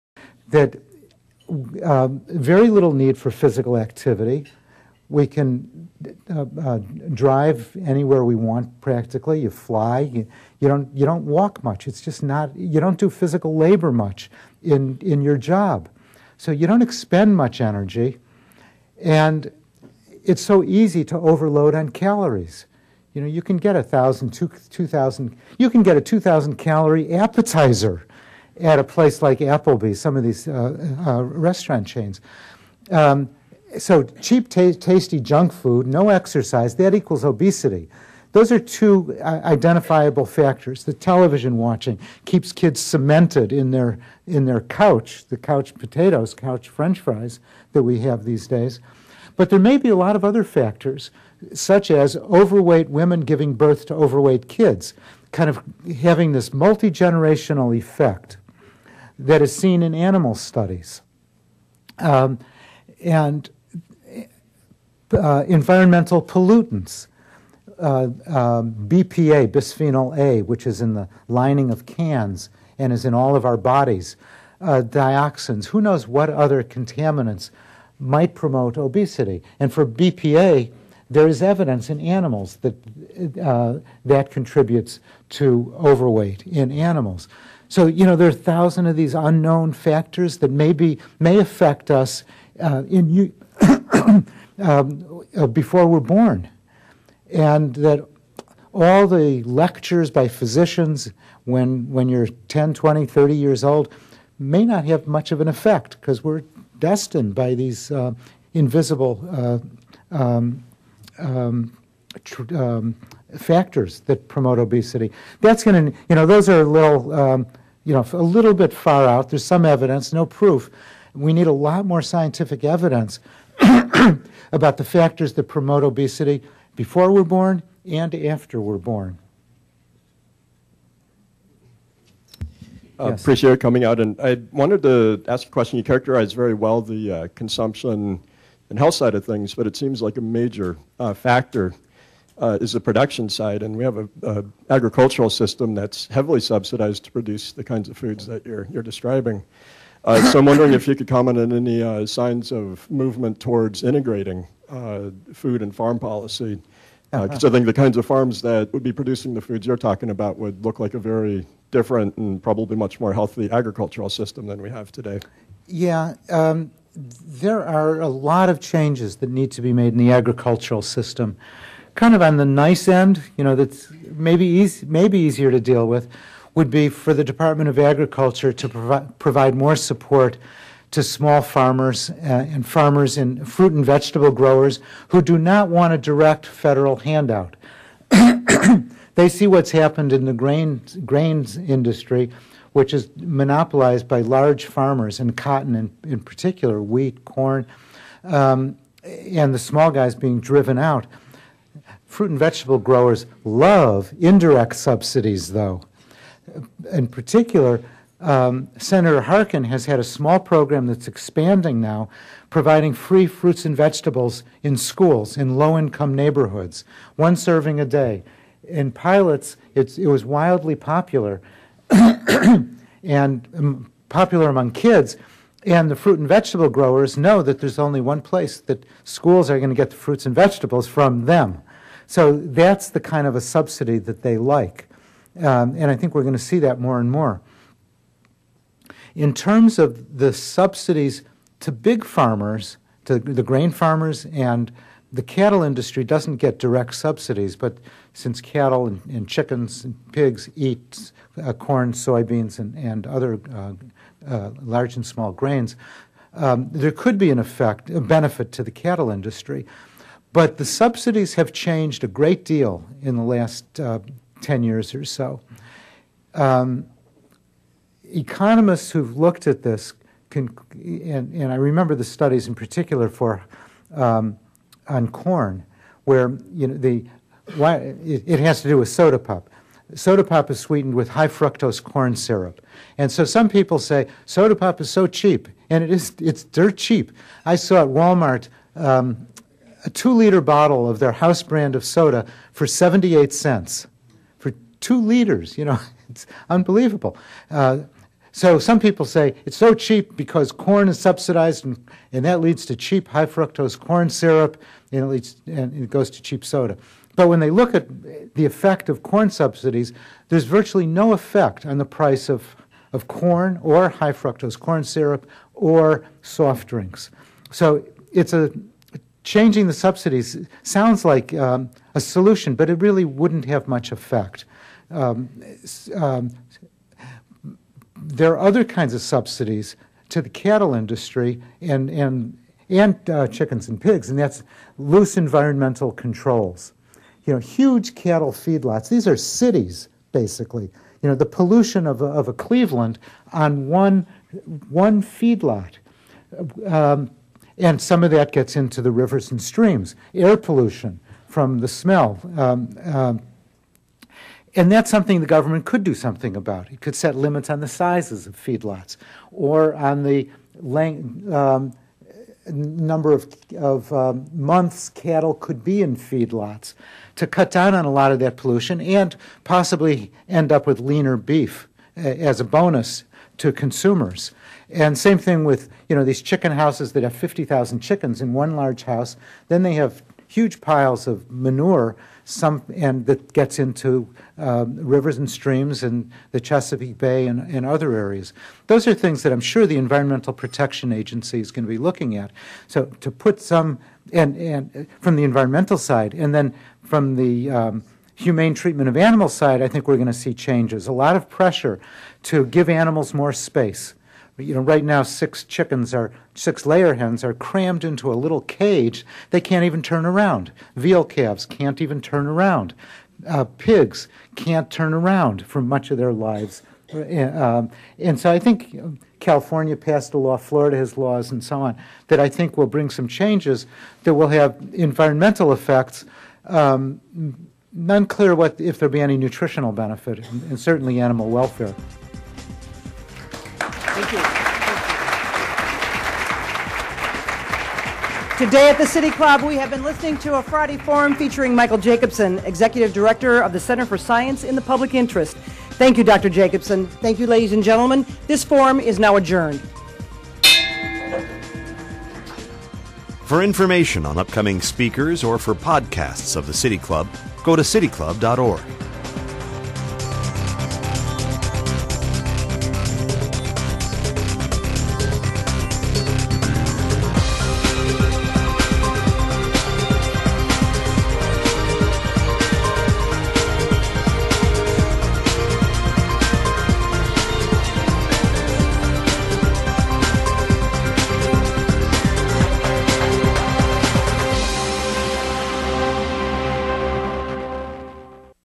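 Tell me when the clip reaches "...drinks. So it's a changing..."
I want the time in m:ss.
5:16.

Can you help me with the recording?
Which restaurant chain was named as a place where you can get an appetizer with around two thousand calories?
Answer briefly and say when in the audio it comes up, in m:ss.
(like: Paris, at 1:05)
Applebee's, at 0:29.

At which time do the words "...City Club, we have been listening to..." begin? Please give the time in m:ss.
7:18.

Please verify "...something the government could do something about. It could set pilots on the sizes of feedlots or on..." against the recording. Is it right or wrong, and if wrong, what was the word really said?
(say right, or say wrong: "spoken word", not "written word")
wrong: "limits", not "pilots".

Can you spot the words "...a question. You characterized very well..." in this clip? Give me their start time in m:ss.
2:15.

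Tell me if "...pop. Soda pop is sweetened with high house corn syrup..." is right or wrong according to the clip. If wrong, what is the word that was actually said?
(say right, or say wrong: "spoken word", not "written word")
wrong: "fructose", not "house".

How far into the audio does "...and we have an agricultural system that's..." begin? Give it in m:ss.
2:23.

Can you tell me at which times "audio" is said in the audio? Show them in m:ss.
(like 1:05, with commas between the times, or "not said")
not said.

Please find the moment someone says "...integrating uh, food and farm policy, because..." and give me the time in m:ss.
2:33.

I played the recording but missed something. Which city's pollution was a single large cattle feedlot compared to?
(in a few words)
Cleveland.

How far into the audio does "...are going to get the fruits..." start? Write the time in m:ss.
3:49.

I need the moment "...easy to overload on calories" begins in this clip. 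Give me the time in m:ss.
0:20.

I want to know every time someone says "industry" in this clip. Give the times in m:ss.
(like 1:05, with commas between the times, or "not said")
3:11, 4:05, 4:19, 5:30.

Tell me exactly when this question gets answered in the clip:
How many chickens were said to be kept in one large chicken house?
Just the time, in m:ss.
6:17.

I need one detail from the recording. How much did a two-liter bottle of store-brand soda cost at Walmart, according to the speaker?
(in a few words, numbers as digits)
78 cents.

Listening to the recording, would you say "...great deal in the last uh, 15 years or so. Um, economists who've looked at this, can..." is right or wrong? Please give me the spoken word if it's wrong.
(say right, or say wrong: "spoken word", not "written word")
wrong: "10", not "15".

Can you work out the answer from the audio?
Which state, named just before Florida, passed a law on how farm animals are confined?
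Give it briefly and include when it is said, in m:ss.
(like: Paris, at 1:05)
California, at 6:59.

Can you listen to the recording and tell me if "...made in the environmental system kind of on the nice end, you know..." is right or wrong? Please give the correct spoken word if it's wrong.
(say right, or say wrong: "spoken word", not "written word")
wrong: "agricultural", not "environmental".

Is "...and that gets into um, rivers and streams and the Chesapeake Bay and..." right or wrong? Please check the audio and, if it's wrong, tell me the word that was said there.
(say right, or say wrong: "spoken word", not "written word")
right.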